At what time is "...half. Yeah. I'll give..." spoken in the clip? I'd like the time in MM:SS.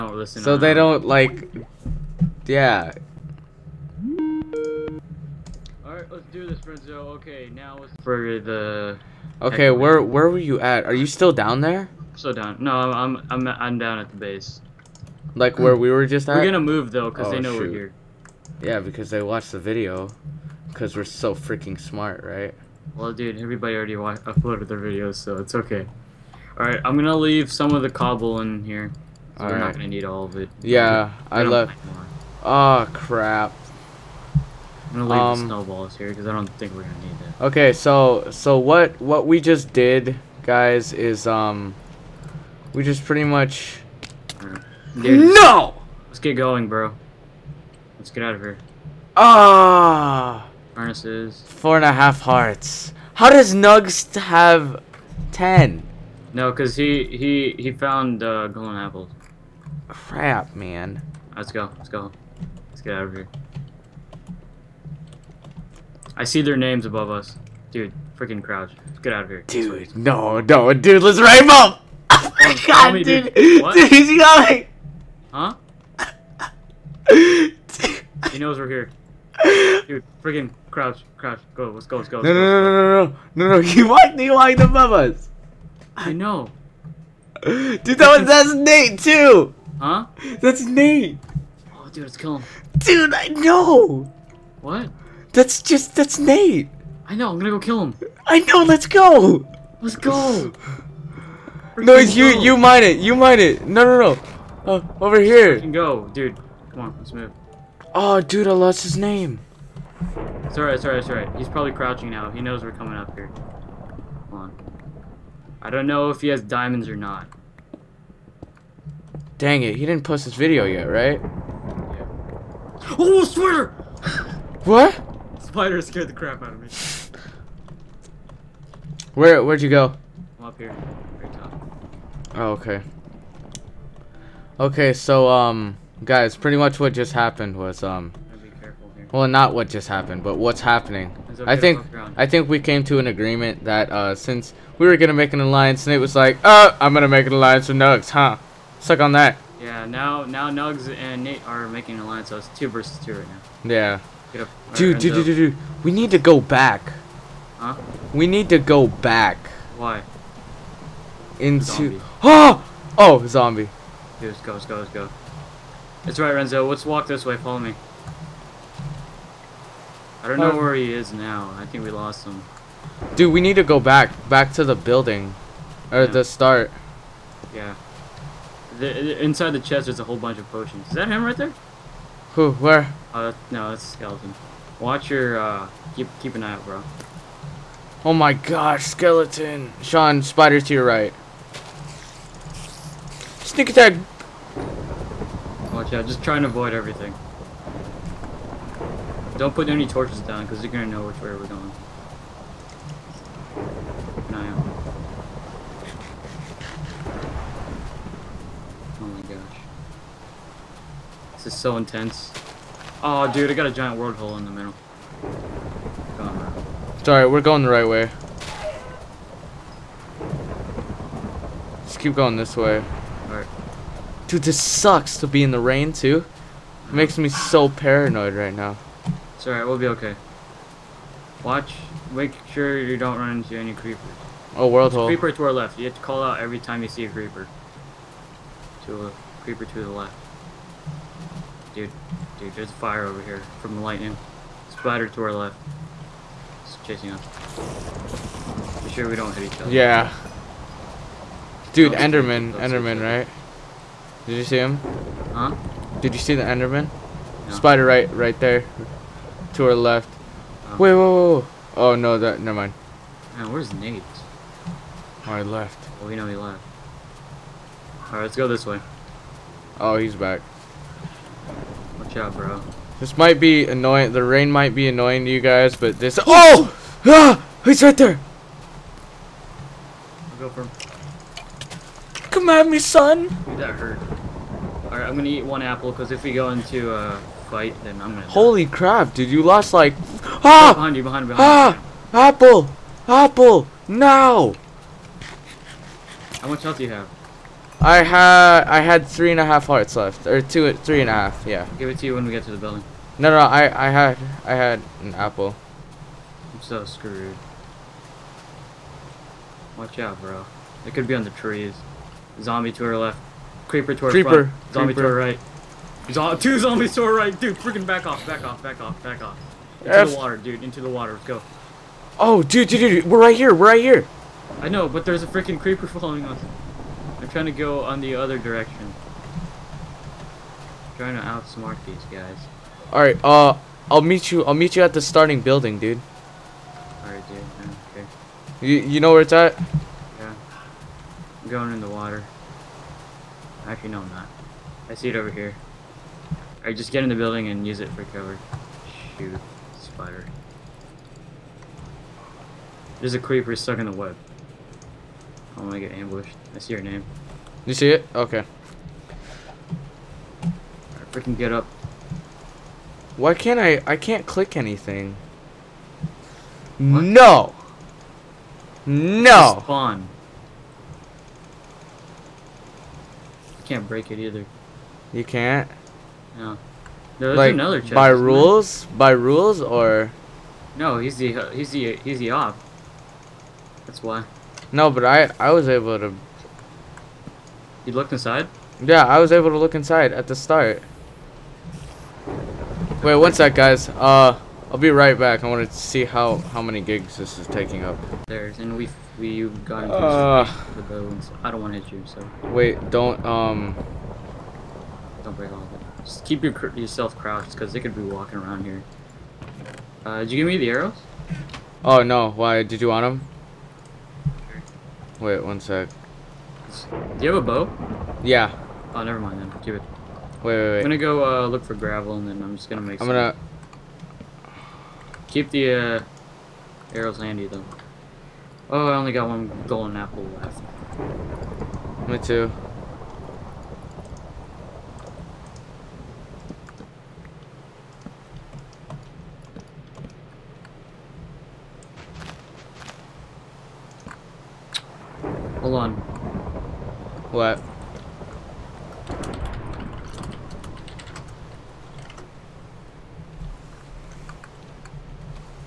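05:01.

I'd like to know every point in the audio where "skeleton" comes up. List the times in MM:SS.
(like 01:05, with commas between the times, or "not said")
03:03, 03:08.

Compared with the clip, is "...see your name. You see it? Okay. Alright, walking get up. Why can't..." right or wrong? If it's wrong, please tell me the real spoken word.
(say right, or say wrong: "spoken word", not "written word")
wrong: "freaking", not "walking".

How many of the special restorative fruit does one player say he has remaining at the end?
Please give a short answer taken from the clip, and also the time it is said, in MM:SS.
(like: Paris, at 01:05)
1, at 07:09.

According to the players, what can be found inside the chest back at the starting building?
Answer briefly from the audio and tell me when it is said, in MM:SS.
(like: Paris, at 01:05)
Potions, at 03:00.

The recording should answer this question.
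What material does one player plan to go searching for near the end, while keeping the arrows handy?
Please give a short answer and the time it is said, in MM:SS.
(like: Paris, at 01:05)
Gravel, at 07:01.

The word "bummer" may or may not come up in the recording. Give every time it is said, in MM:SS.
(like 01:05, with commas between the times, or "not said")
not said.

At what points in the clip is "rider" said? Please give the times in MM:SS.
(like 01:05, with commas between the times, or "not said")
not said.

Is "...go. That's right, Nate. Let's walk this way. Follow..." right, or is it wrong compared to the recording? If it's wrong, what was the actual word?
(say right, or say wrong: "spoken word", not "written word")
wrong: "Renzo", not "Nate".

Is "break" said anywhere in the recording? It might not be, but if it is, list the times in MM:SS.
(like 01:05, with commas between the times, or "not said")
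06:13, 06:45.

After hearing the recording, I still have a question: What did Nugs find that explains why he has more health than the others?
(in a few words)
Golden apples.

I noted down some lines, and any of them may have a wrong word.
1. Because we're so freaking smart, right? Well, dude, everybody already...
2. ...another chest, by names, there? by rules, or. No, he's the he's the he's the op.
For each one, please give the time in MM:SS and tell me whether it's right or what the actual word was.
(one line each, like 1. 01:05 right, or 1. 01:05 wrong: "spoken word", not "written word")
1. 00:20 right
2. 06:17 wrong: "rules", not "names".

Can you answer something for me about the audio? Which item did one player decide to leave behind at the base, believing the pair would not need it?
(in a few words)
Snowballs.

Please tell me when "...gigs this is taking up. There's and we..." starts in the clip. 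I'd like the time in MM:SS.
06:36.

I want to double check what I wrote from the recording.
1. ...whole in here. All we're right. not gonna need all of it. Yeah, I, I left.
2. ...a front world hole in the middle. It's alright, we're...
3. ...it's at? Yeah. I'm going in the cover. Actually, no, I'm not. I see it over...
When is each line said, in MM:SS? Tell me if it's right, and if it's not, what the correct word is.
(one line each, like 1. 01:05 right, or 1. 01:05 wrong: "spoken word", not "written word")
1. 00:27 wrong: "cobble", not "whole"
2. 03:33 wrong: "giant", not "front"
3. 05:39 wrong: "water", not "cover".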